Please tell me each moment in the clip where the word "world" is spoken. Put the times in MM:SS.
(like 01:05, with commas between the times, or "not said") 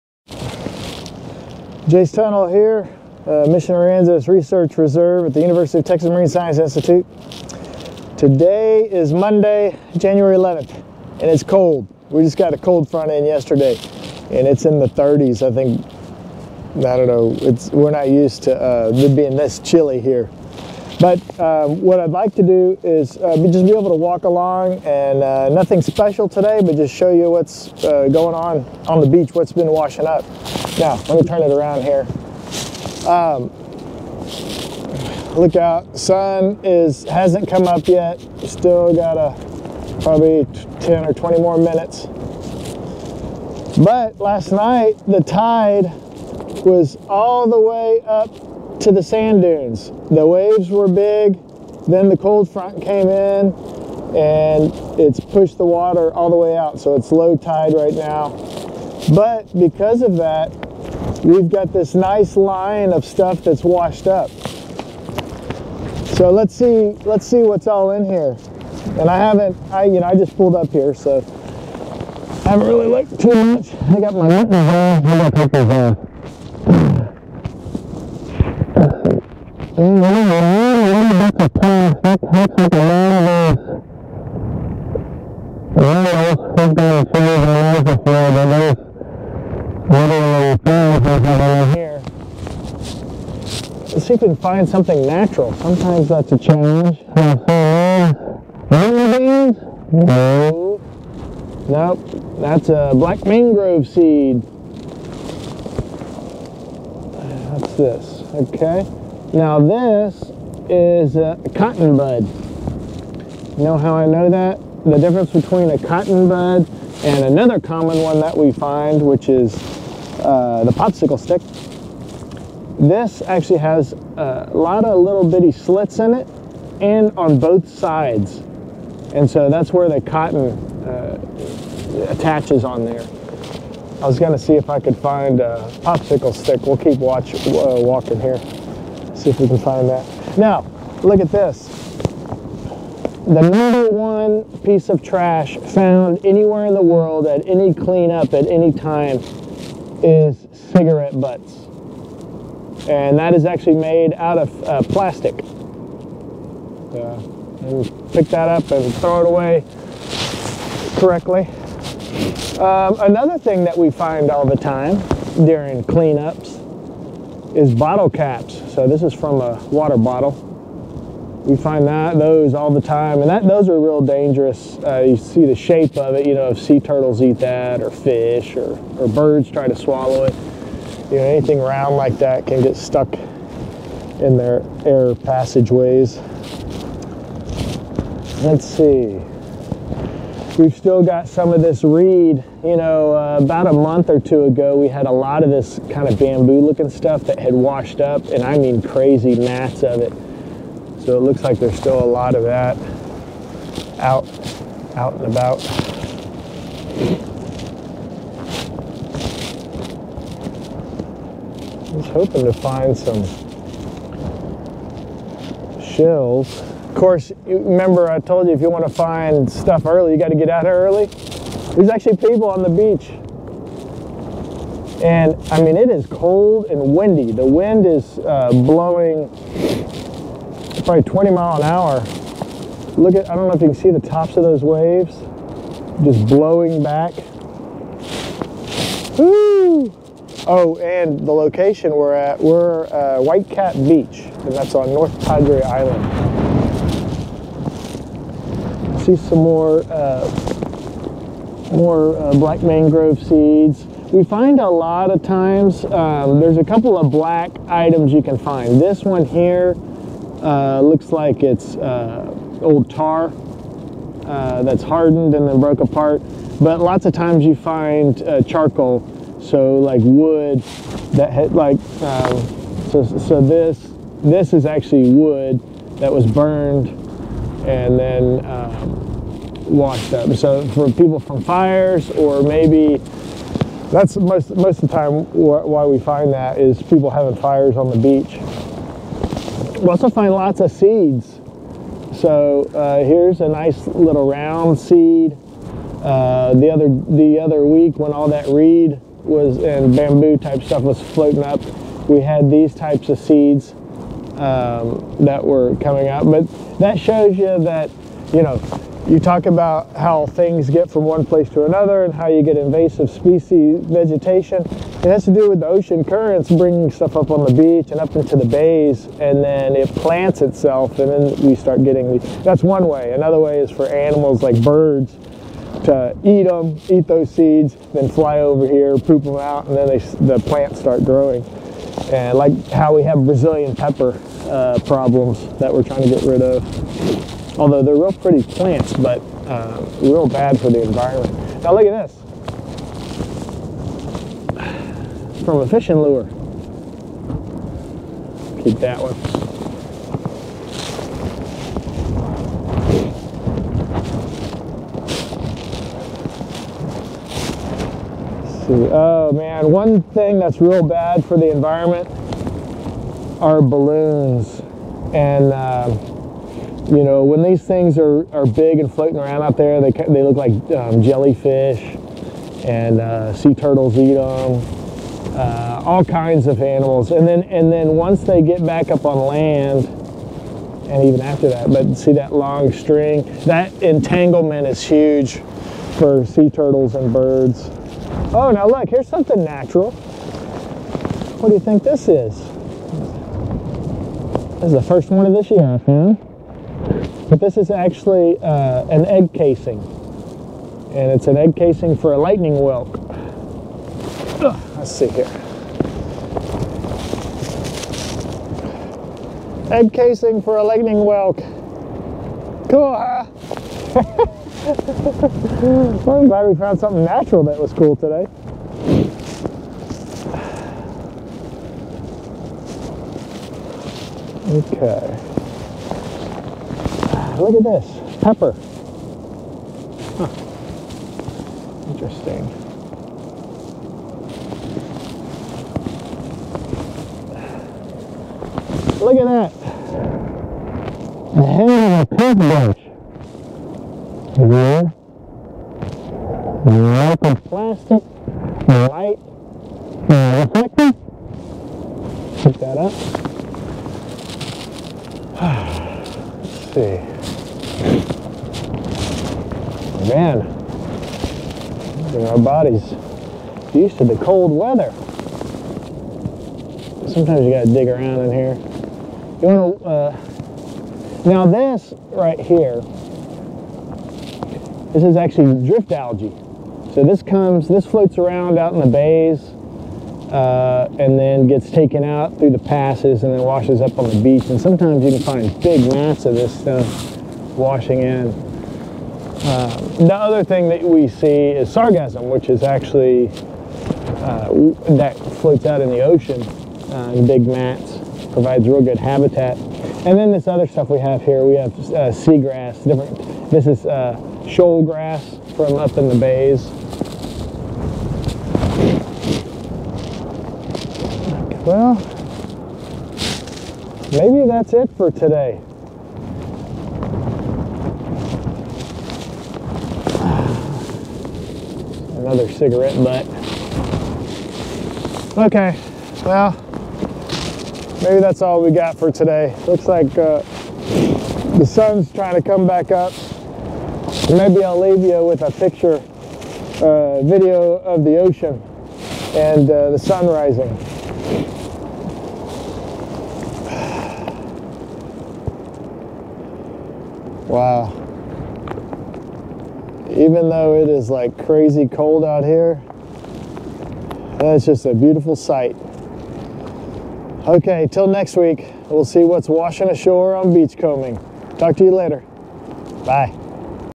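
02:26.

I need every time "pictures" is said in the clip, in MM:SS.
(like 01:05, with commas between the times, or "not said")
01:15, 08:55.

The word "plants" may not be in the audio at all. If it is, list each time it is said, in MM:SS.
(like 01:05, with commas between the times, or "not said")
05:19, 05:30, 05:38.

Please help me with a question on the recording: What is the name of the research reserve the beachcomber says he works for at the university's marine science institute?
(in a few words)
Mission Aransas Research Reserve.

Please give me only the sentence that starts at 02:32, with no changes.
And that is actually made out of uh, plastic.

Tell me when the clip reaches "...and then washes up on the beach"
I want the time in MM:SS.
08:03.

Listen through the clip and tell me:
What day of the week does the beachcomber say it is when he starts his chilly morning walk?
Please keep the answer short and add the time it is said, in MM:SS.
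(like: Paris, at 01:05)
Monday, at 00:09.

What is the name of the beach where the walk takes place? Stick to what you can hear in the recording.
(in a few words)
White Cat Beach.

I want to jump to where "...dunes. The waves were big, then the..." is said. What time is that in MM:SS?
00:49.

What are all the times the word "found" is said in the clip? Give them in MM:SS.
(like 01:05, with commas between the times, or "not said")
02:25, 06:35, 06:56.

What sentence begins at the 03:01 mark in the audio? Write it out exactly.
You know, anything round like that can get stuck in their air passageways.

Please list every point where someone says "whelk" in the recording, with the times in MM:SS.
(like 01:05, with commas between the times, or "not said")
06:42, 06:51.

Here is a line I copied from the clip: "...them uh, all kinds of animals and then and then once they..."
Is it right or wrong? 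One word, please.
right.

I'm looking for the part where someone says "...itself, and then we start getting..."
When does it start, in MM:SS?
05:20.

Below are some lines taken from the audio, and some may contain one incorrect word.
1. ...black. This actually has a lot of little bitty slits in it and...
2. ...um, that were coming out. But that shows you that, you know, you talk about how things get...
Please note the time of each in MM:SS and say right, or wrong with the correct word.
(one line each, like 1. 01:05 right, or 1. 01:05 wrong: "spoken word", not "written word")
1. 02:01 wrong: "stick", not "black"
2. 05:04 right.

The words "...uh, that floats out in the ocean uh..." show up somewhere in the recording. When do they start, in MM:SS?
08:14.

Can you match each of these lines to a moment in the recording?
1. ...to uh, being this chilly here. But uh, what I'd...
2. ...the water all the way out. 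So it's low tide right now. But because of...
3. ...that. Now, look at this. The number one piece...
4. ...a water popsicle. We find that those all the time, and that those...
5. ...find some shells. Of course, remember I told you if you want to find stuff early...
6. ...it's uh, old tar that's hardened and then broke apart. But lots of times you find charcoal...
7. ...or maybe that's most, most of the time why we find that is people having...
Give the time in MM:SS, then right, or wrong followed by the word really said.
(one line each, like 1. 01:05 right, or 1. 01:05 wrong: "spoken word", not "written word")
1. 00:18 right
2. 00:55 right
3. 02:19 right
4. 02:49 wrong: "bottle", not "popsicle"
5. 03:32 right
6. 04:21 right
7. 04:42 right.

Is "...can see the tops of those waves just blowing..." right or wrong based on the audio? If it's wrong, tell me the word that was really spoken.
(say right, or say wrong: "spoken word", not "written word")
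right.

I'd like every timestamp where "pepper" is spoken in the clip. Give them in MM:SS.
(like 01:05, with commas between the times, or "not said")
05:33, 07:08.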